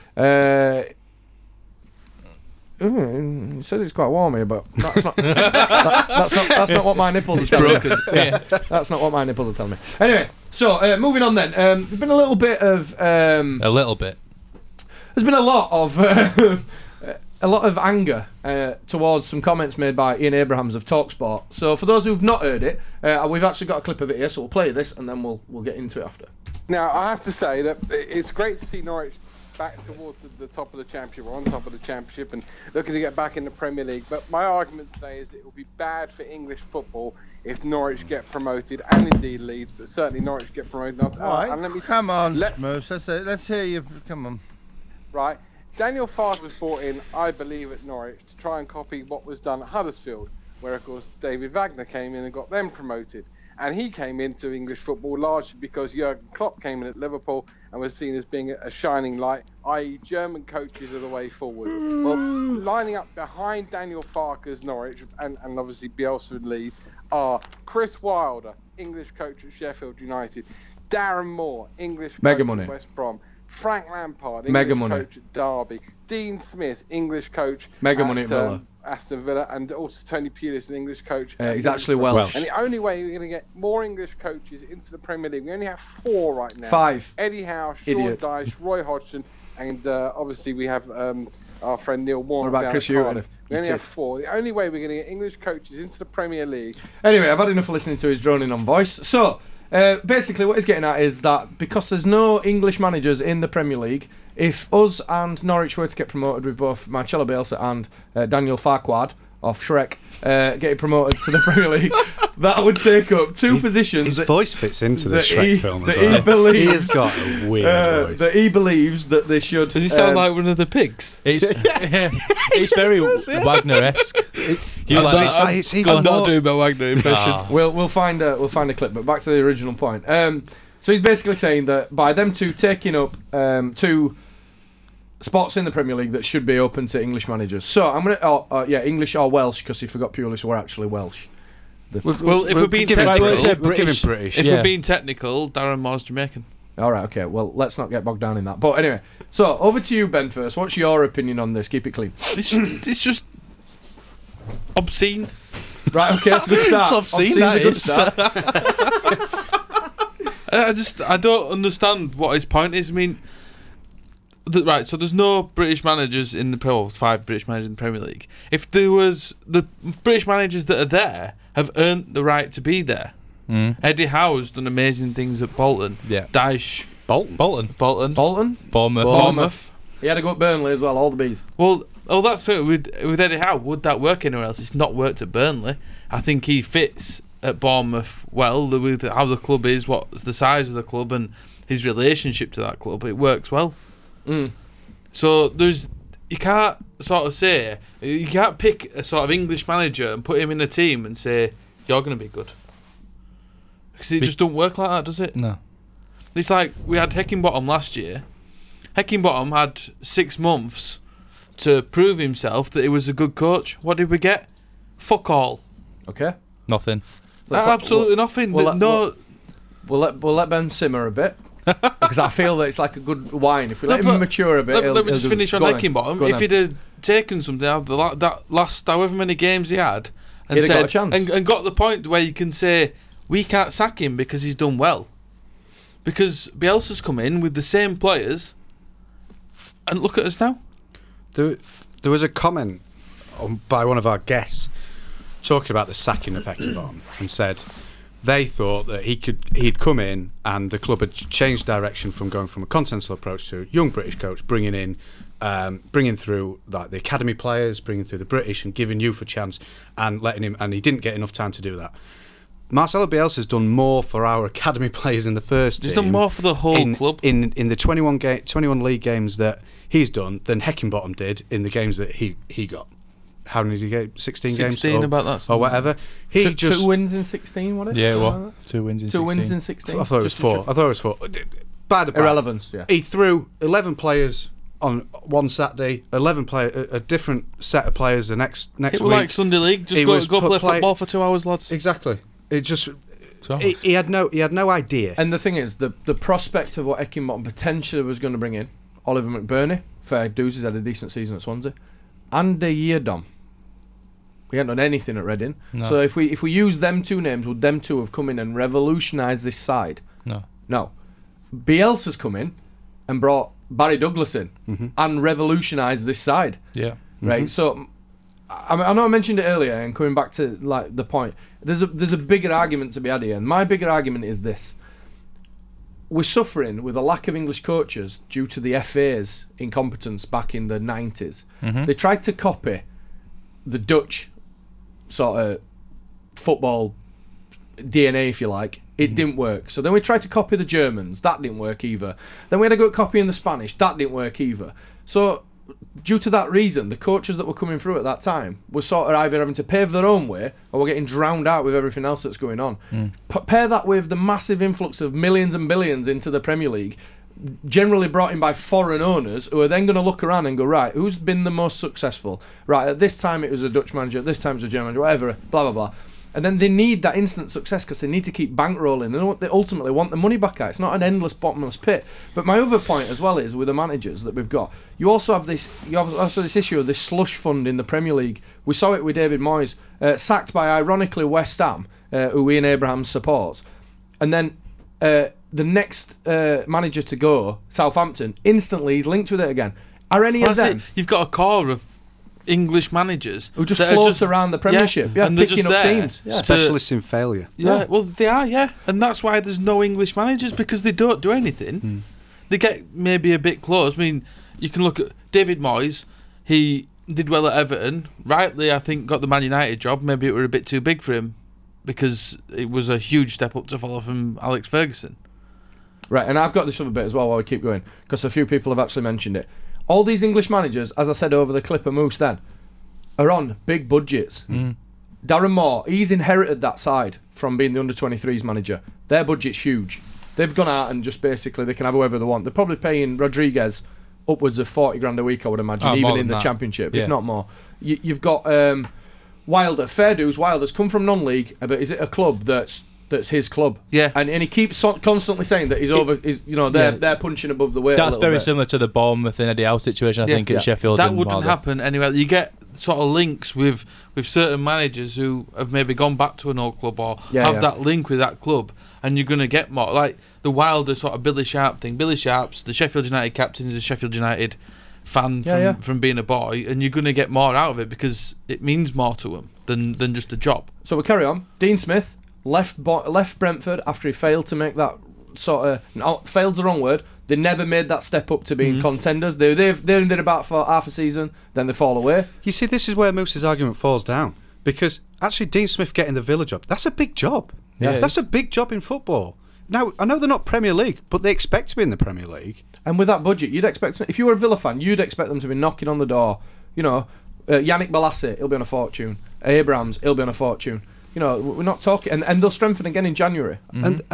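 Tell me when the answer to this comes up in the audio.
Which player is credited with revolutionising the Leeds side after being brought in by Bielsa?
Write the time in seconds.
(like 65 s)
313 s.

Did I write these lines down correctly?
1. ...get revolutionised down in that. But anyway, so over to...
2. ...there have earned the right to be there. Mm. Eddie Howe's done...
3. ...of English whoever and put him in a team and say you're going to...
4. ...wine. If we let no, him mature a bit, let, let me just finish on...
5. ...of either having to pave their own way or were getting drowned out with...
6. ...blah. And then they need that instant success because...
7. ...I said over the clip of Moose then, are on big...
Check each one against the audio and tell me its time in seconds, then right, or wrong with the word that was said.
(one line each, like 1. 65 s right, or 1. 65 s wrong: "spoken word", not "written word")
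1. 147 s wrong: "bogged", not "revolutionised"
2. 170 s right
3. 199 s wrong: "manager", not "whoever"
4. 223 s right
5. 349 s right
6. 365 s right
7. 421 s right.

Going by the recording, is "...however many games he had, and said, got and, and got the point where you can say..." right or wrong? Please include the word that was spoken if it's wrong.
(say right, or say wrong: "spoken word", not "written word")
right.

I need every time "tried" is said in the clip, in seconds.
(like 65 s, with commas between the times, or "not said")
331 s, 339 s.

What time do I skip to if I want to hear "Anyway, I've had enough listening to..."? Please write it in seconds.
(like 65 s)
97 s.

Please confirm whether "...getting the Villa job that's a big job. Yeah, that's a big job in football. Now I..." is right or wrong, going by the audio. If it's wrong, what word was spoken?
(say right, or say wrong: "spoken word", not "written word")
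right.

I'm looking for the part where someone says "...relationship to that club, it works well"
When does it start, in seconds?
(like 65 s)
191 s.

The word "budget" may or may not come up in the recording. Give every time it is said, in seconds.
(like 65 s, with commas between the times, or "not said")
423 s, 429 s, 493 s.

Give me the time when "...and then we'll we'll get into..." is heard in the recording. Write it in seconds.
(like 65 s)
24 s.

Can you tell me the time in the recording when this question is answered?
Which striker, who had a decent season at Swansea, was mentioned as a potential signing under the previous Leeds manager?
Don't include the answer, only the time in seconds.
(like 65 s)
299 s.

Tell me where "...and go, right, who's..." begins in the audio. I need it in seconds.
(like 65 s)
360 s.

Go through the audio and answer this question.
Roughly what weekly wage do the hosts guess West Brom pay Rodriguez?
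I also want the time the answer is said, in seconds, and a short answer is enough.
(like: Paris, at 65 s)
40 grand, at 434 s.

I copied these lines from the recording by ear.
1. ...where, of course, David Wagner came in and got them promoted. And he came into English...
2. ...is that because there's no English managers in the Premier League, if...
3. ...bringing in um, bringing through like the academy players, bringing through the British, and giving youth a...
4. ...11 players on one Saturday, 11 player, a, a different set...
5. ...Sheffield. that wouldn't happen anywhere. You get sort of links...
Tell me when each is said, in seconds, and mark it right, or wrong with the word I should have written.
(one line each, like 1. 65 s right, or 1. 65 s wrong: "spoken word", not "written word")
1. 50 s right
2. 100 s right
3. 254 s right
4. 283 s right
5. 450 s right.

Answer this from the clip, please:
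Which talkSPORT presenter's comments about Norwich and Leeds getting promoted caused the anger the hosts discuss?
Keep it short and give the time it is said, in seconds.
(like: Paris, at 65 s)
Ian Abrahams, at 20 s.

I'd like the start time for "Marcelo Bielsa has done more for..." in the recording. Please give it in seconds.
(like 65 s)
262 s.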